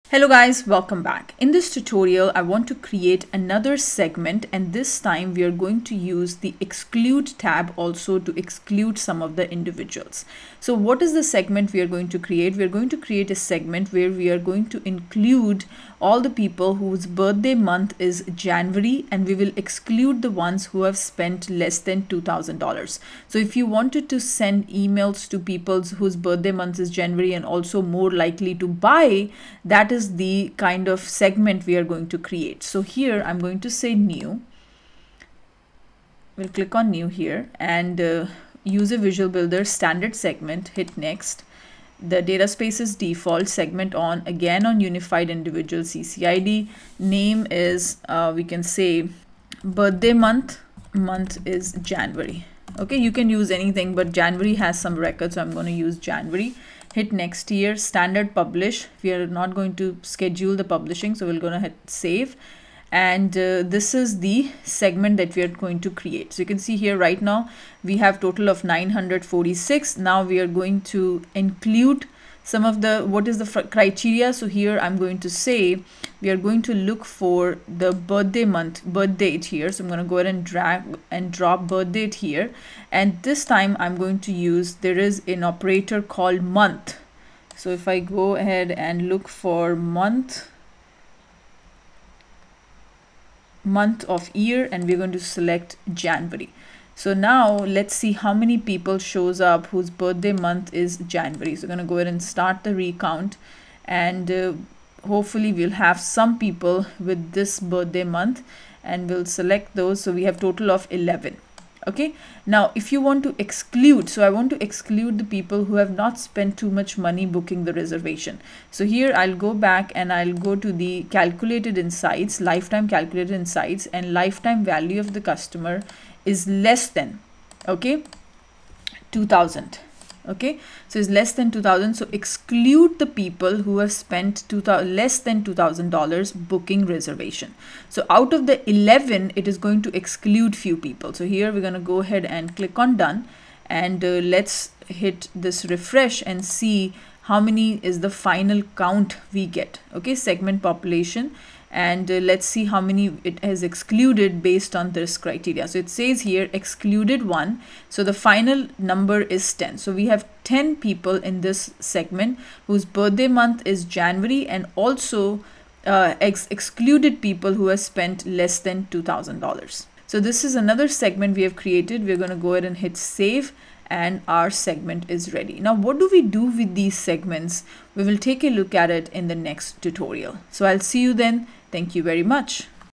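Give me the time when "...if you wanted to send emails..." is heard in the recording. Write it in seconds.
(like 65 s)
23 s.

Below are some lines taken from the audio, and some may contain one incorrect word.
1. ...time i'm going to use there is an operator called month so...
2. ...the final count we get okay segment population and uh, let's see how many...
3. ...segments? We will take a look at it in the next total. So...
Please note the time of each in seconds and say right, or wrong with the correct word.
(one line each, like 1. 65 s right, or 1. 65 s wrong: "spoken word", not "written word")
1. 83 s right
2. 148 s right
3. 176 s wrong: "tutorial", not "total".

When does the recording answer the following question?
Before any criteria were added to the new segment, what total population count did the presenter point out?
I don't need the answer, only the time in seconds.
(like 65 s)
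68 s.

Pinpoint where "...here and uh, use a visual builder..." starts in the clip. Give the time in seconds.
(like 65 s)
37 s.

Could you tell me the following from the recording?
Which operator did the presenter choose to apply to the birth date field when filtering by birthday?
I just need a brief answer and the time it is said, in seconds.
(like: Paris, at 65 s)
month of year, at 93 s.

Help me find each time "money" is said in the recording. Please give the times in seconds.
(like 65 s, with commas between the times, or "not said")
116 s.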